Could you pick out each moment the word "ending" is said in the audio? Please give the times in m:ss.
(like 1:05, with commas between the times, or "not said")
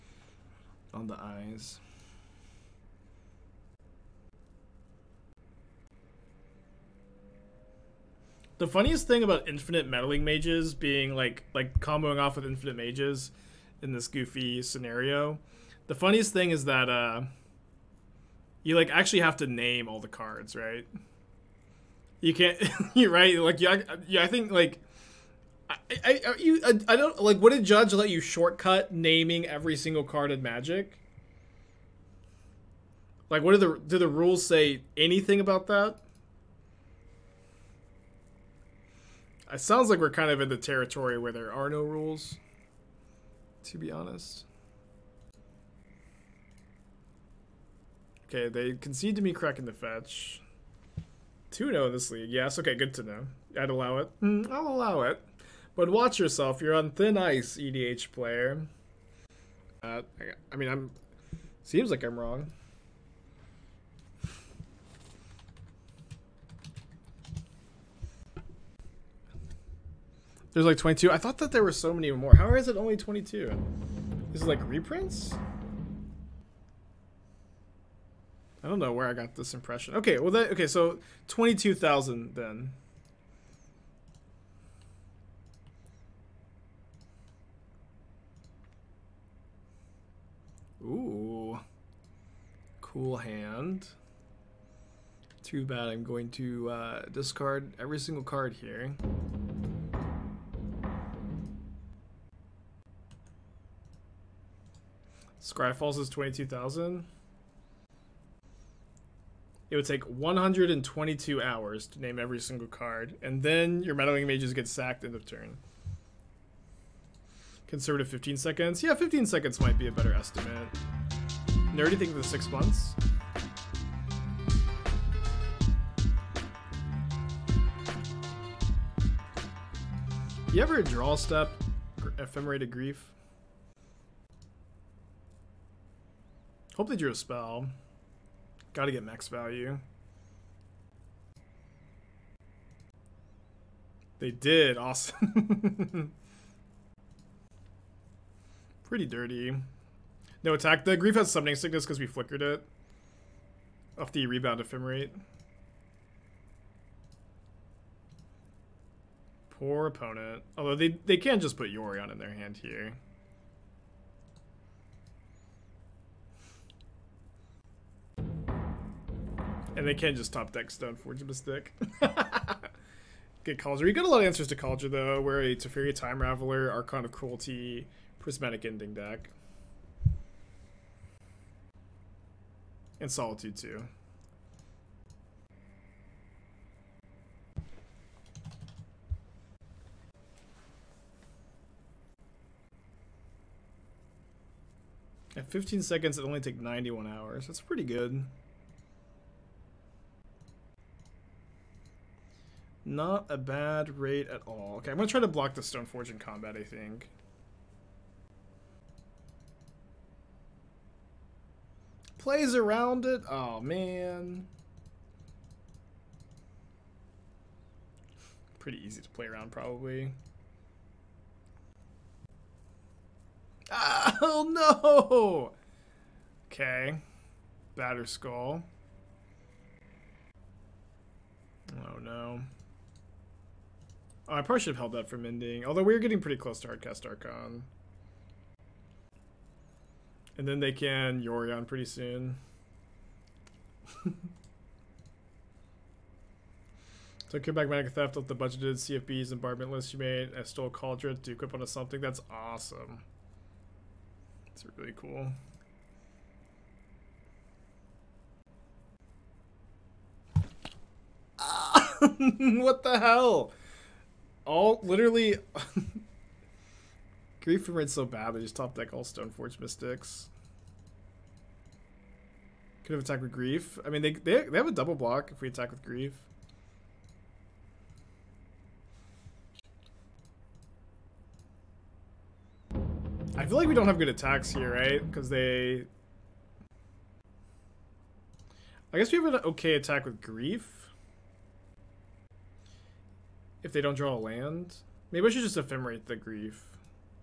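2:58, 3:55.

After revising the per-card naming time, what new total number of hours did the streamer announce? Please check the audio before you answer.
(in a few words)
91.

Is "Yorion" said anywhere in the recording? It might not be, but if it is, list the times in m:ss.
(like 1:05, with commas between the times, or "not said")
2:41, 4:01.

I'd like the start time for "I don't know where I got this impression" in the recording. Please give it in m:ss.
1:18.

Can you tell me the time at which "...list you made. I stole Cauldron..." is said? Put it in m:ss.
4:09.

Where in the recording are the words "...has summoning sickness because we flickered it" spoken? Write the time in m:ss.
2:31.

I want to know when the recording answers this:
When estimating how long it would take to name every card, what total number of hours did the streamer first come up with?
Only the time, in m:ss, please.
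1:50.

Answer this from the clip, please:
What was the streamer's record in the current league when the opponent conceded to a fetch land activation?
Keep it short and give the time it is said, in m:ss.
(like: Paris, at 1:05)
2-0, at 0:51.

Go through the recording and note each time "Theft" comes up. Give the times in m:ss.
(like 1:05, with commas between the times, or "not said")
4:07.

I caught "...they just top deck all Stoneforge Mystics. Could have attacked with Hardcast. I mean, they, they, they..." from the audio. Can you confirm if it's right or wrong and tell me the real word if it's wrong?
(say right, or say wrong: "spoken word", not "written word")
wrong: "Grief", not "Hardcast".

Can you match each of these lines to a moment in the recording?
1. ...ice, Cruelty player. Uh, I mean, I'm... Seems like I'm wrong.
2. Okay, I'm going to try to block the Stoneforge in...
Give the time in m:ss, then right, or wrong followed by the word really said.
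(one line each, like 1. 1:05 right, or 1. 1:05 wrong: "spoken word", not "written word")
1. 0:57 wrong: "EDH", not "Cruelty"
2. 3:24 right.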